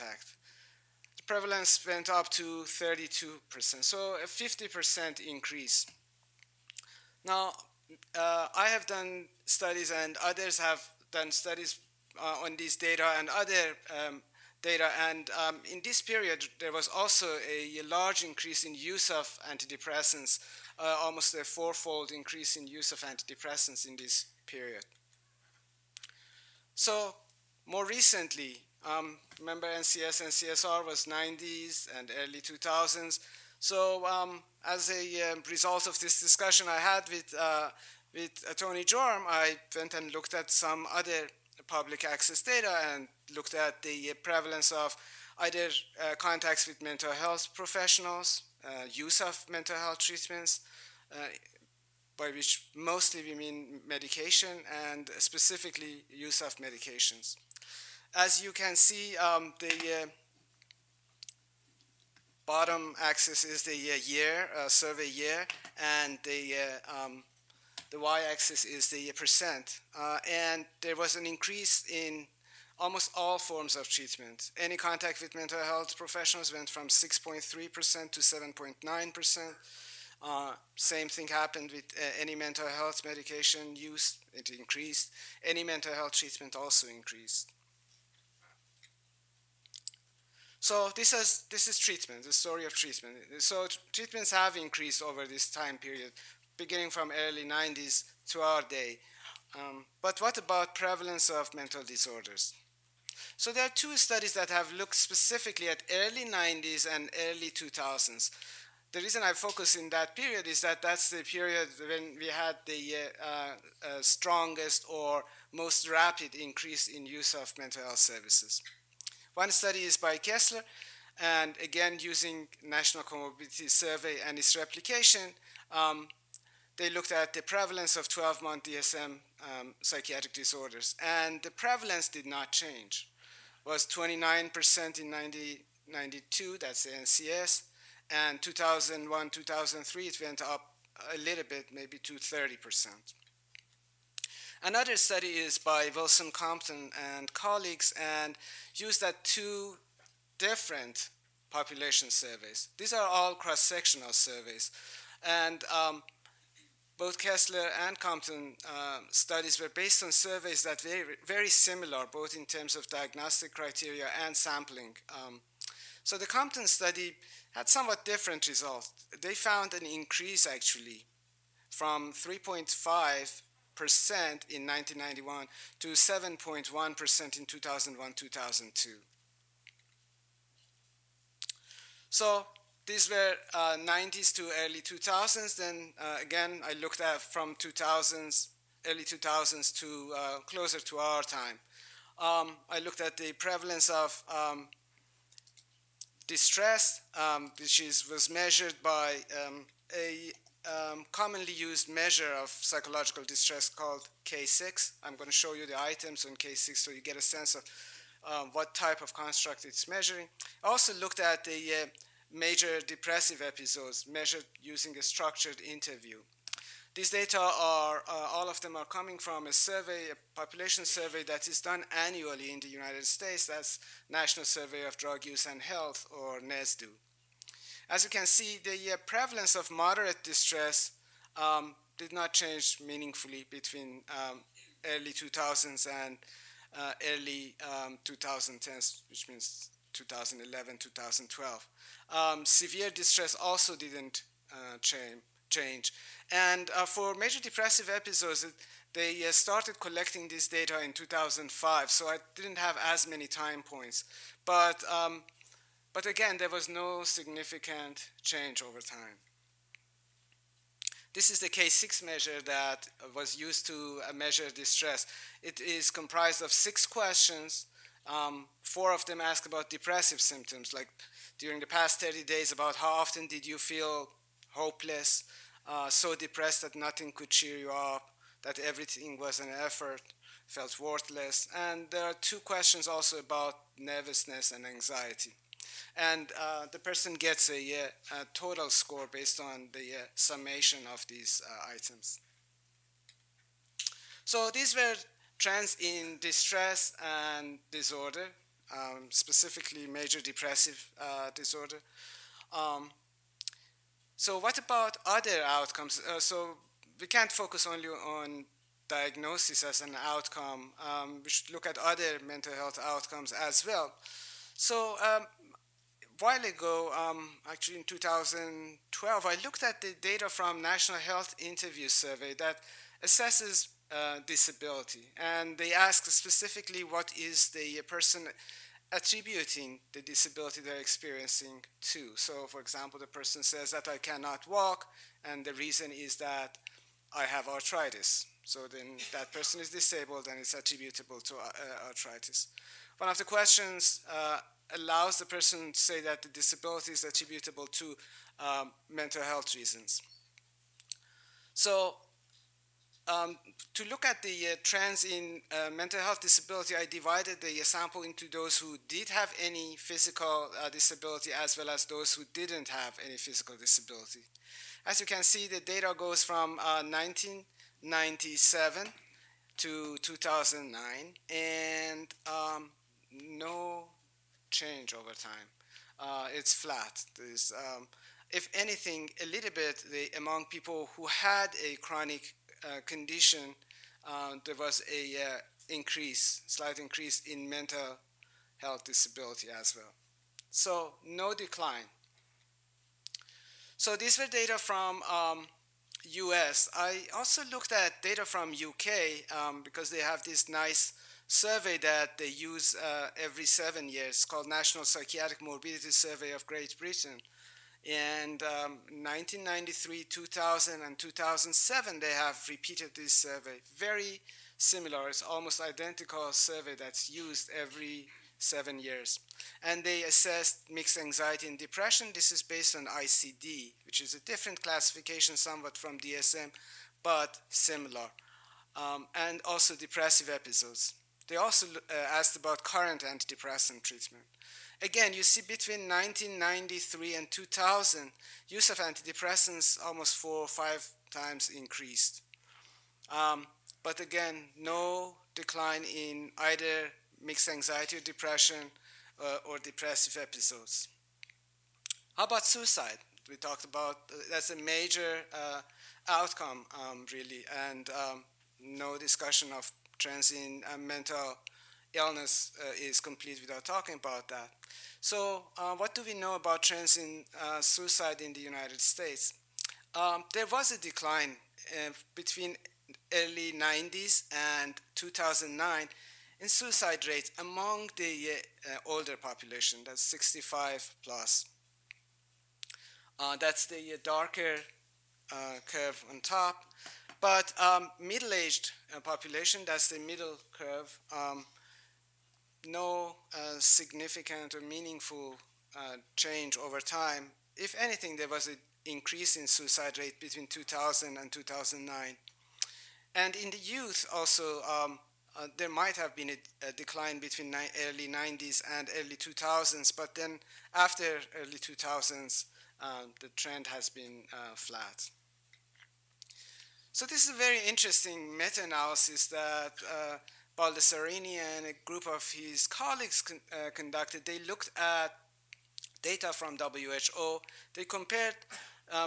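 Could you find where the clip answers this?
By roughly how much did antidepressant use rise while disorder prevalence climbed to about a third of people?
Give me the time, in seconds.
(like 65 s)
21 s.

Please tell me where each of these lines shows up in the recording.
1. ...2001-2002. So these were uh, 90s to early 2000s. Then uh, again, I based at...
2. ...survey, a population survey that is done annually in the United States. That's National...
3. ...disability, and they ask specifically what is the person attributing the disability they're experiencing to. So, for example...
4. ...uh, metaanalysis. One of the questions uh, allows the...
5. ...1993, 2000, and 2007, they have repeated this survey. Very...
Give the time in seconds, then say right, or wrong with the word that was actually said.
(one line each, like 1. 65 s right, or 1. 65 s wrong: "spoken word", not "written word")
1. 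177 s wrong: "looked", not "based"
2. 219 s right
3. 324 s right
4. 341 s wrong: "arthritis", not "metaanalysis"
5. 408 s right.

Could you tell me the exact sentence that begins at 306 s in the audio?
Uh, so we can't focus only on diagnosis as an outcome.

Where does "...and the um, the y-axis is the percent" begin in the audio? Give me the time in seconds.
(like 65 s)
66 s.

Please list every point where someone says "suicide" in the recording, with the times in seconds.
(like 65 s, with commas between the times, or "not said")
452 s, 467 s, 476 s, 499 s.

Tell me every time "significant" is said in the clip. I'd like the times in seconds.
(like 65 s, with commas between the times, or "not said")
257 s, 493 s.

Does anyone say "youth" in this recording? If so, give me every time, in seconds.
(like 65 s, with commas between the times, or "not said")
503 s.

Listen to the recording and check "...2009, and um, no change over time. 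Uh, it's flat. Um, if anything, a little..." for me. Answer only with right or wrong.
right.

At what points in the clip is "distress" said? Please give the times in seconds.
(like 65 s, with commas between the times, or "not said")
196 s, 203 s, 230 s, 242 s, 264 s, 296 s.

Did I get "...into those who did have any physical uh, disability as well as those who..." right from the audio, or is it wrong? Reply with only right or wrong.
right.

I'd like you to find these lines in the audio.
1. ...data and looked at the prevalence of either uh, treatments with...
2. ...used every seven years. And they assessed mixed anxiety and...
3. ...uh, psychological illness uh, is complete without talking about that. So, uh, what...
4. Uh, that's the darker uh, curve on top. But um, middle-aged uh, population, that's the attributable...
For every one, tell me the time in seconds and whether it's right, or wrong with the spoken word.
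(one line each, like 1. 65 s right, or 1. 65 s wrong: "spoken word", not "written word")
1. 42 s wrong: "contacts", not "treatments"
2. 417 s right
3. 460 s wrong: "mental", not "psychological"
4. 483 s wrong: "middle", not "attributable".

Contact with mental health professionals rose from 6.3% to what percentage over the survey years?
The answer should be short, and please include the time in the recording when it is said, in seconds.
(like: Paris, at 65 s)
7.9%, at 78 s.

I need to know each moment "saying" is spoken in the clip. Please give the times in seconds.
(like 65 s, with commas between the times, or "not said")
not said.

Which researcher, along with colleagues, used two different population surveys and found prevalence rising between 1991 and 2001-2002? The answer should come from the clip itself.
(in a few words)
Wilson Compton.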